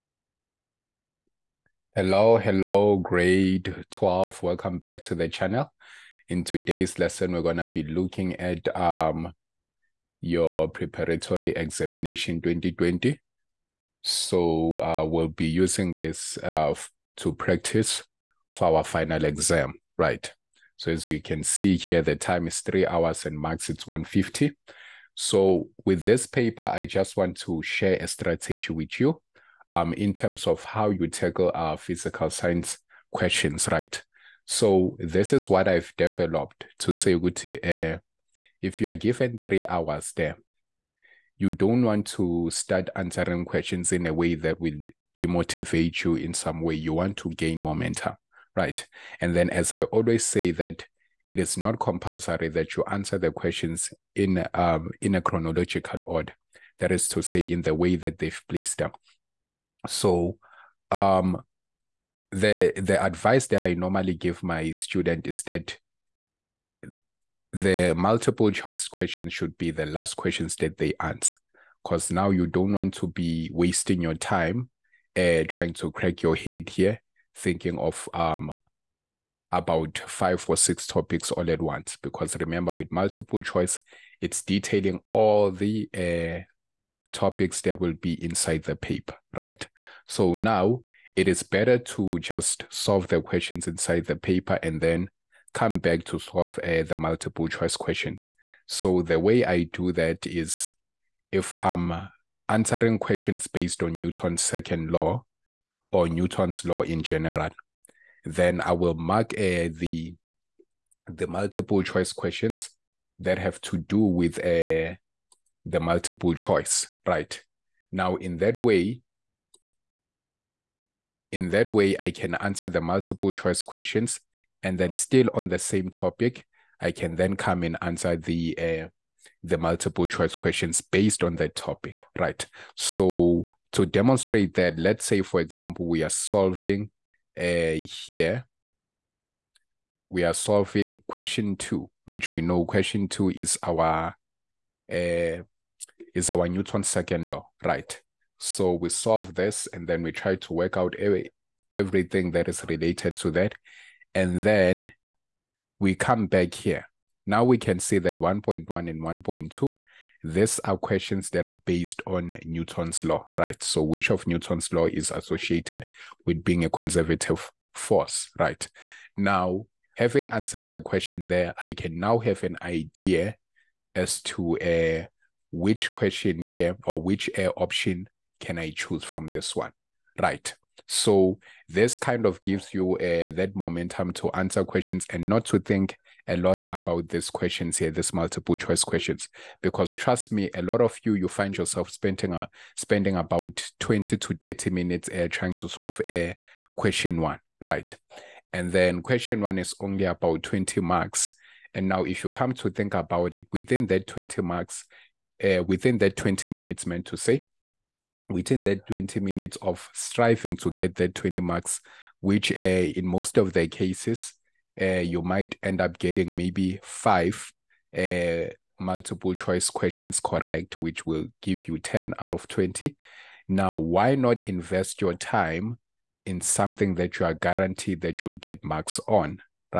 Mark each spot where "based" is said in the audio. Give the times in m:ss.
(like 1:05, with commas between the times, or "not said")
1:43, 2:10, 2:41.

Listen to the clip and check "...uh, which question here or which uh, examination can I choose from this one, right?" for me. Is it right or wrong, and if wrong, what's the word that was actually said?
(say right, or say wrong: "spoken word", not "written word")
wrong: "option", not "examination".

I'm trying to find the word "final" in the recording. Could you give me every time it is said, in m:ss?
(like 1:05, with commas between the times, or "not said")
0:18.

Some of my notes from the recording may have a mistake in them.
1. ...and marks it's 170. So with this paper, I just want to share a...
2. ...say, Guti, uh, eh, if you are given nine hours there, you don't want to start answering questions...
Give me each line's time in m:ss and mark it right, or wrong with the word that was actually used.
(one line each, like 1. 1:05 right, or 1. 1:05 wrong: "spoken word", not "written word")
1. 0:23 wrong: "150", not "170"
2. 0:36 wrong: "three", not "nine".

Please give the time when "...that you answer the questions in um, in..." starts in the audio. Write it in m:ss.
0:52.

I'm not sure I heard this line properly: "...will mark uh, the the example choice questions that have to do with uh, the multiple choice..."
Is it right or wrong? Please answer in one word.
wrong.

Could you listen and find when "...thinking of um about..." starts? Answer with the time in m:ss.
1:17.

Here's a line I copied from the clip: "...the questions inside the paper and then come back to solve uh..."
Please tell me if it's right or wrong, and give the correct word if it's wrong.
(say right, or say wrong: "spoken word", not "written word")
right.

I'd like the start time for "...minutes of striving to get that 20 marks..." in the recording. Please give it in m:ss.
3:29.